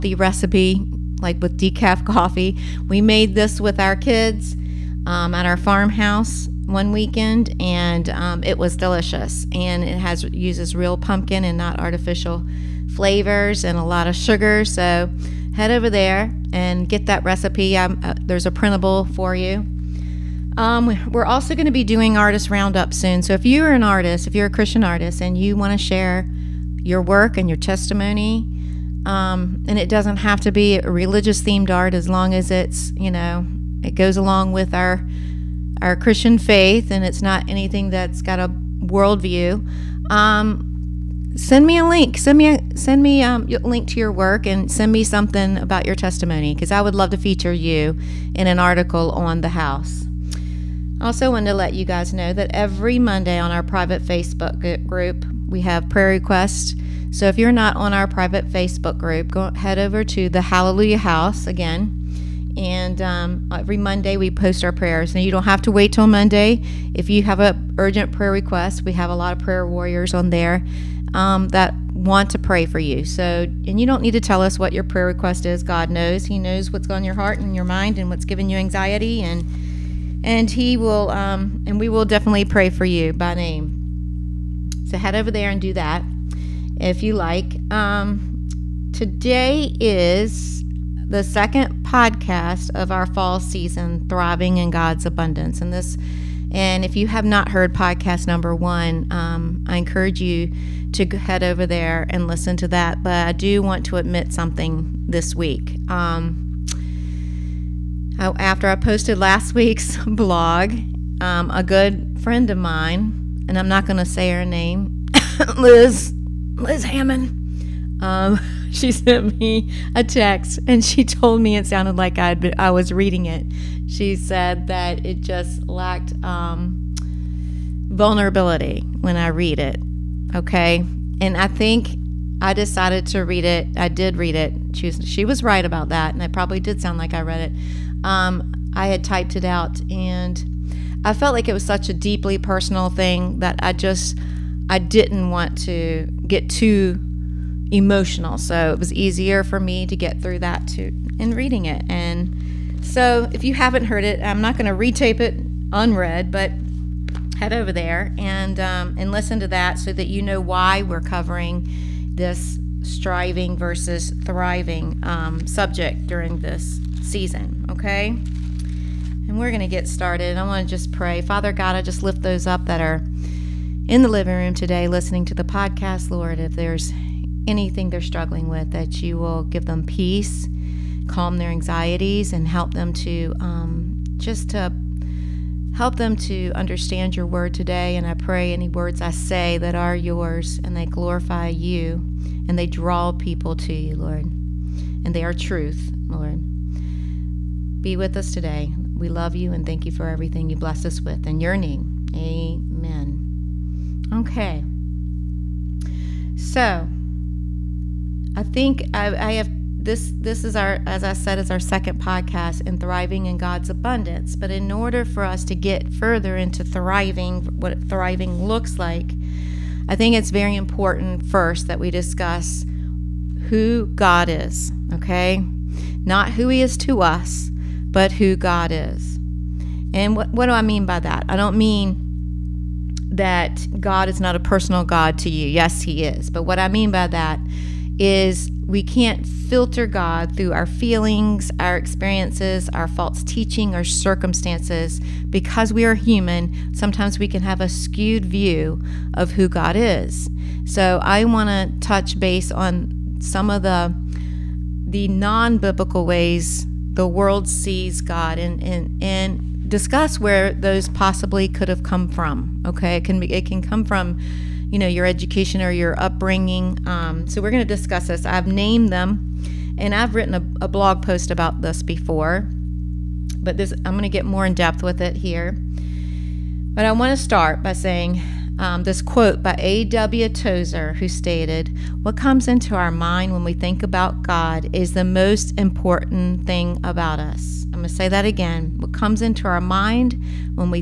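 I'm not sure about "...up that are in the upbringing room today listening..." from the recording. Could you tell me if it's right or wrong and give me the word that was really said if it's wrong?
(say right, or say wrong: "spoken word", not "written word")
wrong: "living", not "upbringing".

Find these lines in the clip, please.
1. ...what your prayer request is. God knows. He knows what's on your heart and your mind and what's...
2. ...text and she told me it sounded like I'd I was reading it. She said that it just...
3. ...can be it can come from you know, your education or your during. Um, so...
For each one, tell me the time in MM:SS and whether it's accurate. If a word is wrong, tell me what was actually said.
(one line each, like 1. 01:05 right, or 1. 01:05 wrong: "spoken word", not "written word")
1. 01:14 right
2. 02:00 right
3. 04:23 wrong: "upbringing", not "during".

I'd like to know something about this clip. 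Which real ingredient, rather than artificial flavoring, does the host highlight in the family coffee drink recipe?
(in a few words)
Pumpkin.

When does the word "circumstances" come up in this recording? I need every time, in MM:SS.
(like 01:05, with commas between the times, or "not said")
04:03.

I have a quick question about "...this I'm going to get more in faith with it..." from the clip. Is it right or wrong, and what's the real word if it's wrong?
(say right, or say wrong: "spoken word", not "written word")
wrong: "depth", not "faith".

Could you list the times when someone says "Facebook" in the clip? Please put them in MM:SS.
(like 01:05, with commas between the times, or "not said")
00:54, 00:58.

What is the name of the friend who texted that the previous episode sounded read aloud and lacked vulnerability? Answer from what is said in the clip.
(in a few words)
Liz Hammond.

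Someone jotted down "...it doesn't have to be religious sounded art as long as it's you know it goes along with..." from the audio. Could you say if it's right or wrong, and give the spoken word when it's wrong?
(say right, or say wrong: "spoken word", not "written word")
wrong: "themed", not "sounded".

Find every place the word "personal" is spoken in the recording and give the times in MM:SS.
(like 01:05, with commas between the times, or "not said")
02:22, 03:54.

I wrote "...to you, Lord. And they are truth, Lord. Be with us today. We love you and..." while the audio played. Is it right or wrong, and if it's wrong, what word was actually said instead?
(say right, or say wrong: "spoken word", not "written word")
right.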